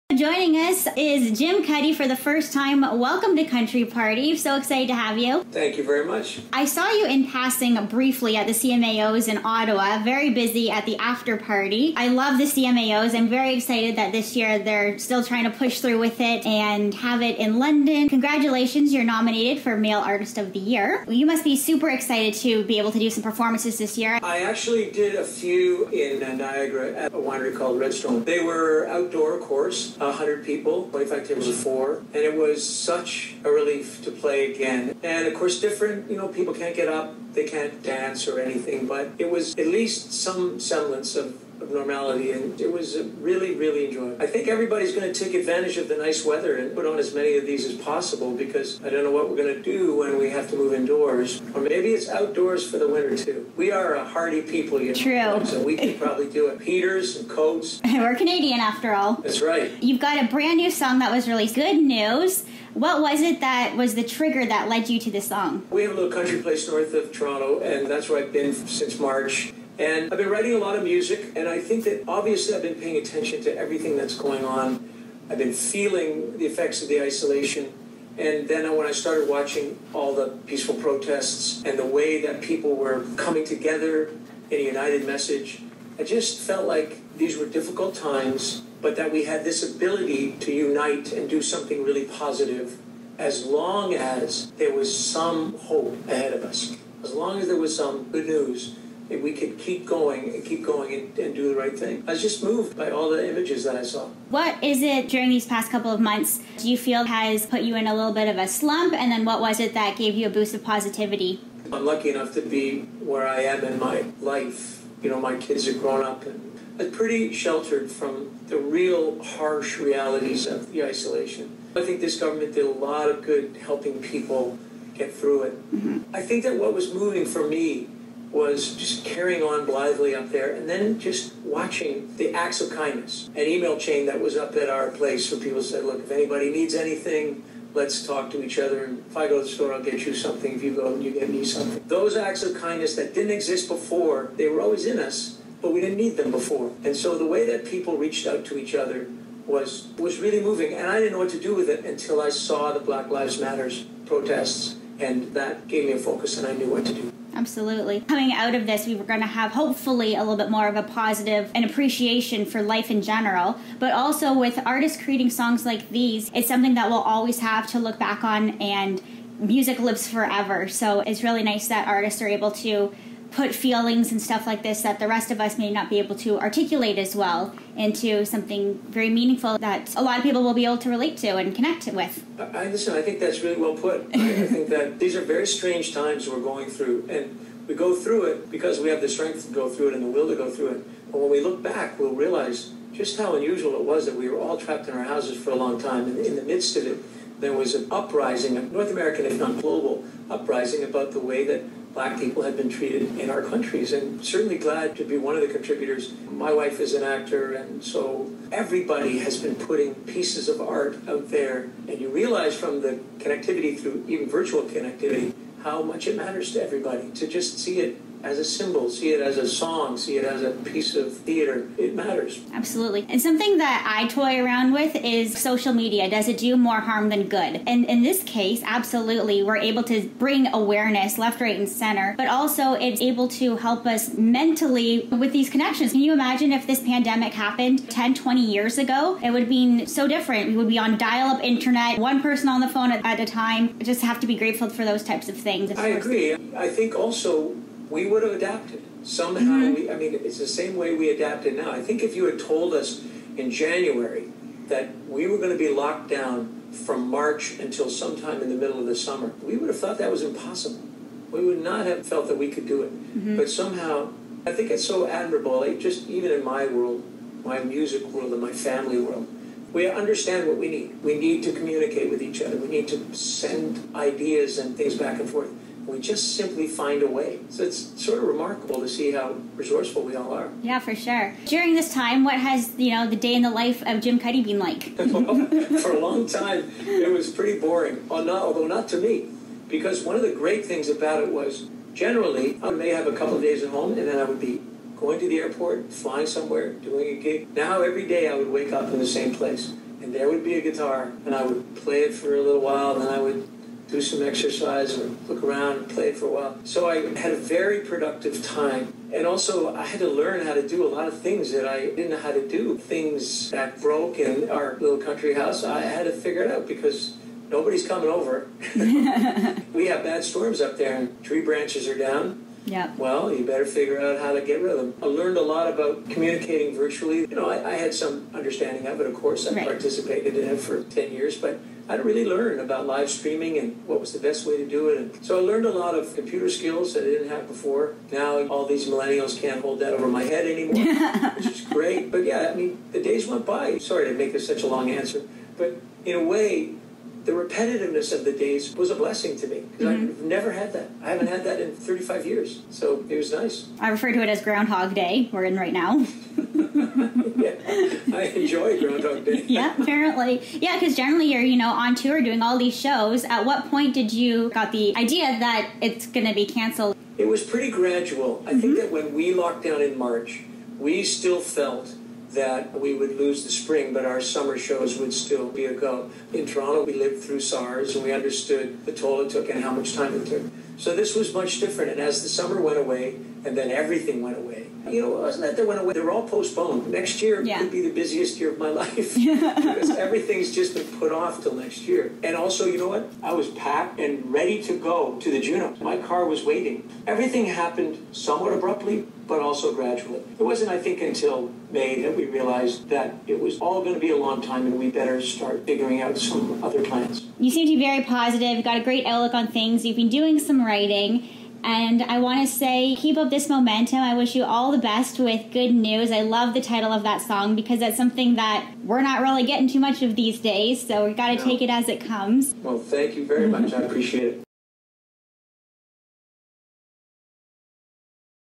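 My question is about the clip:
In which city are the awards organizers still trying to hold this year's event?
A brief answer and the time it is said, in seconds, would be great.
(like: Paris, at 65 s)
London, at 17 s.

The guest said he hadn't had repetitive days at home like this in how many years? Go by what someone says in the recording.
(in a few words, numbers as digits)
35.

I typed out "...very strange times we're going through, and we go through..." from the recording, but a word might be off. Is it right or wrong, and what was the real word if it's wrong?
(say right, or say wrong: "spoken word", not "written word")
right.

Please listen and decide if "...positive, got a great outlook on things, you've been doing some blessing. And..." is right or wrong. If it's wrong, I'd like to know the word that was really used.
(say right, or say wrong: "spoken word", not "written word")
wrong: "writing", not "blessing".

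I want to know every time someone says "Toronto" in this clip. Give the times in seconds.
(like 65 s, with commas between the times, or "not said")
67 s, 376 s.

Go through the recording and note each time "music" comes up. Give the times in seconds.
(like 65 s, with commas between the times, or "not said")
70 s, 169 s, 267 s.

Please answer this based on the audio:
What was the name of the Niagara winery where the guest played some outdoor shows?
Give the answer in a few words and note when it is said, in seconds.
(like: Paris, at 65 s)
Redstone, at 27 s.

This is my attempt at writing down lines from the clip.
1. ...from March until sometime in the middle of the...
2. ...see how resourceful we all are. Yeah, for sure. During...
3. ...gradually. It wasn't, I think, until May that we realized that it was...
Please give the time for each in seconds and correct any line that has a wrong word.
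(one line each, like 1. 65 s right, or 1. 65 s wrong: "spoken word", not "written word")
1. 256 s right
2. 278 s right
3. 399 s right.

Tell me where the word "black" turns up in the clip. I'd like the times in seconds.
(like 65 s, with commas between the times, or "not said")
152 s, 201 s.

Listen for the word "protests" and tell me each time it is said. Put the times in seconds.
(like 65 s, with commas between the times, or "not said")
80 s, 154 s.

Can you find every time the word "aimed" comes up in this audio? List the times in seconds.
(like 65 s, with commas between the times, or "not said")
not said.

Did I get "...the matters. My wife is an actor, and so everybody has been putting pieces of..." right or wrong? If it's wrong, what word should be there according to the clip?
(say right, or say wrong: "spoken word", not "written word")
wrong: "contributors", not "matters".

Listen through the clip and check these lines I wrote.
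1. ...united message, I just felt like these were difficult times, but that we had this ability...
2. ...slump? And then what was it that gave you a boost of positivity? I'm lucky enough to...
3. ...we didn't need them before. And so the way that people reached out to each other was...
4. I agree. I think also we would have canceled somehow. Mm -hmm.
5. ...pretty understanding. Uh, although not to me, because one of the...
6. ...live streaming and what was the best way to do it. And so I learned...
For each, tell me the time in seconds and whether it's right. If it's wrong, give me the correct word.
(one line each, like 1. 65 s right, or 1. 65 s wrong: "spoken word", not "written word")
1. 84 s right
2. 108 s right
3. 145 s right
4. 245 s wrong: "adapted", not "canceled"
5. 287 s wrong: "boring", not "understanding"
6. 332 s right.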